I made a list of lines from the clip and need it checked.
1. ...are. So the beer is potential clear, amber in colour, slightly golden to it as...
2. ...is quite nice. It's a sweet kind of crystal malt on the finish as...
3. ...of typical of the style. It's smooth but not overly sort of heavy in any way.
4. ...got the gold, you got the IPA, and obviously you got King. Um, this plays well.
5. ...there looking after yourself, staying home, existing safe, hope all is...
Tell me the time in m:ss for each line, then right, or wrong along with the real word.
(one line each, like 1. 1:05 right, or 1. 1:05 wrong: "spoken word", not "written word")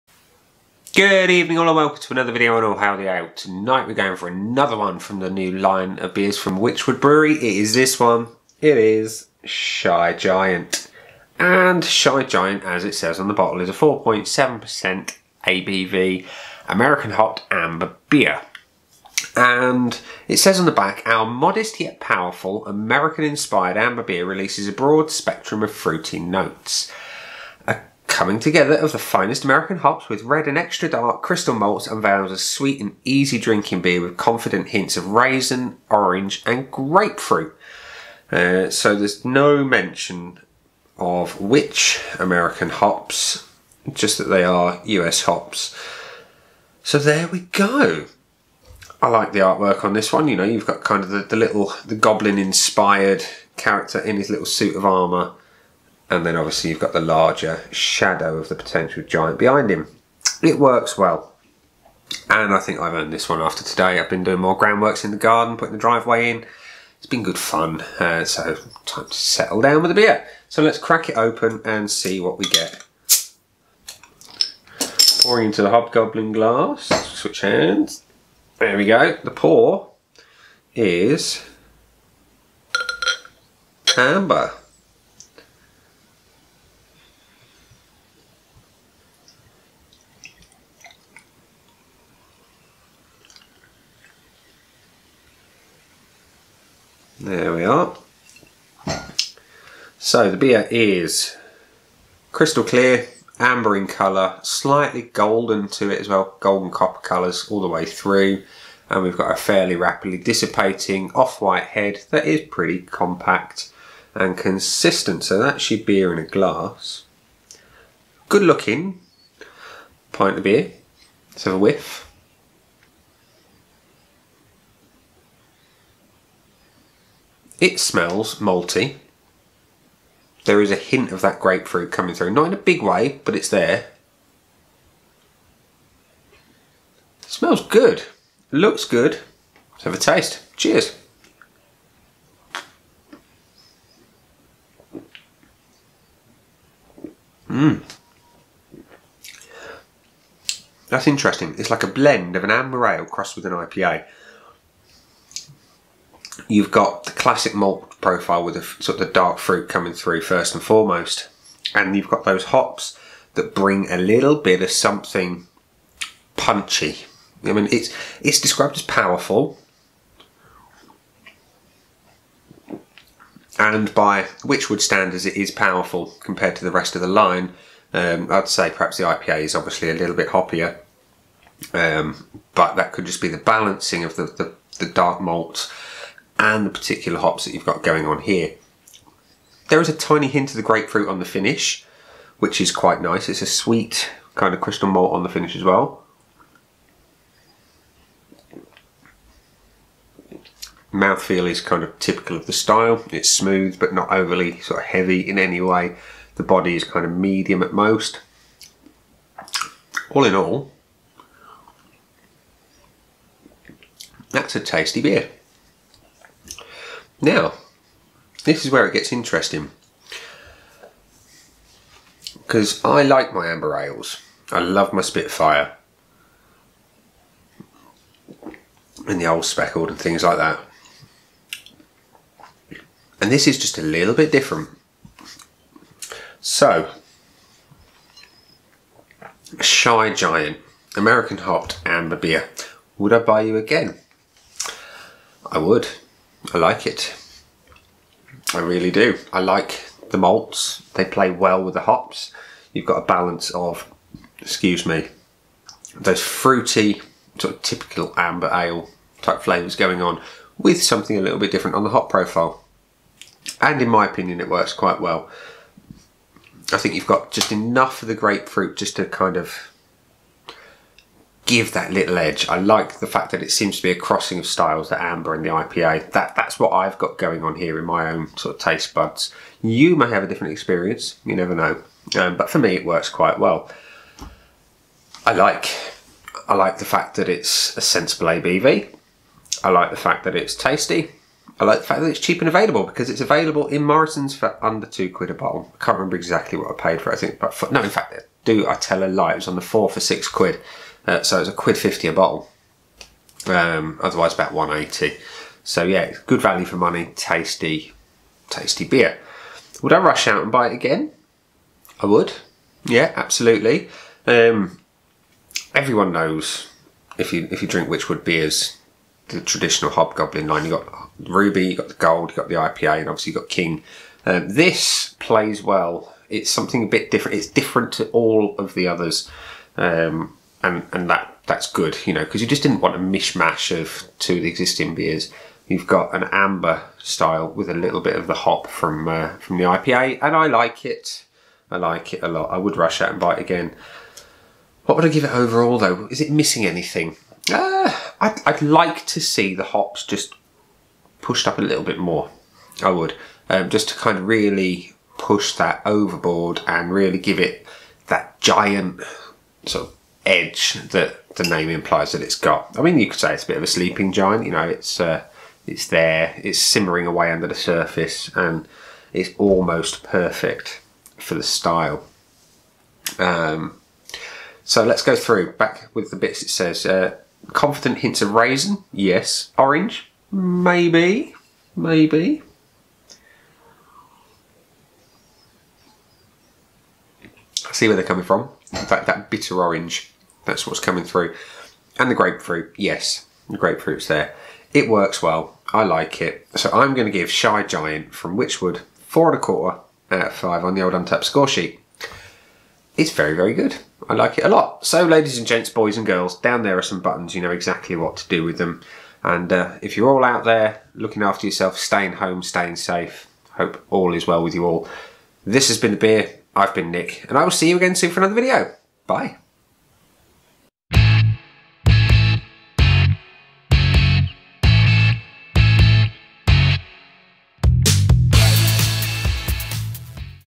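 1. 1:37 wrong: "crystal", not "potential"
2. 3:12 right
3. 3:21 right
4. 5:21 right
5. 6:50 wrong: "staying", not "existing".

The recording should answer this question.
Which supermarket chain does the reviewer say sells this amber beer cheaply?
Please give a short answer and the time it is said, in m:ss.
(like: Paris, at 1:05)
Morrison's, at 4:53.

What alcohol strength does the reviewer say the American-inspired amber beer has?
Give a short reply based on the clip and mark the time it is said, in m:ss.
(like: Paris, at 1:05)
4.7%, at 0:13.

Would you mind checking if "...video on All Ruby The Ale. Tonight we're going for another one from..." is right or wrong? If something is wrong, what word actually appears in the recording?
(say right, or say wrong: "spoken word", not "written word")
wrong: "Hail", not "Ruby".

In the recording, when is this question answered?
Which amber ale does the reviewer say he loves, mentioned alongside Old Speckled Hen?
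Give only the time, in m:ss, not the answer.
3:45.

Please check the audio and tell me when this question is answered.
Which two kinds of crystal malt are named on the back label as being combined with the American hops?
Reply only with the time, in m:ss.
0:30.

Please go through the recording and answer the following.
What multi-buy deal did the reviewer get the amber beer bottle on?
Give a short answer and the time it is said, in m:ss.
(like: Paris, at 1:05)
four for six quid, at 4:59.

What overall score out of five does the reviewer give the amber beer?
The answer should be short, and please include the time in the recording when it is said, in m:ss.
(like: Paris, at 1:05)
4.25, at 6:39.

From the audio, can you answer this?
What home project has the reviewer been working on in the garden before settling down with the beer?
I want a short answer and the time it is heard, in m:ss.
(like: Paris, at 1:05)
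putting the driveway in, at 1:05.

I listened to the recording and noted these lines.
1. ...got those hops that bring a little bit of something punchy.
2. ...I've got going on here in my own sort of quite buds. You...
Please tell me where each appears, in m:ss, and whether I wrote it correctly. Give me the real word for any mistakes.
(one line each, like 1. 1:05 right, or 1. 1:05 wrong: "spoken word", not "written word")
1. 2:42 right
2. 4:36 wrong: "taste", not "quite".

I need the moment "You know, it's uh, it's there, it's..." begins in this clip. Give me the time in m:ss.
6:04.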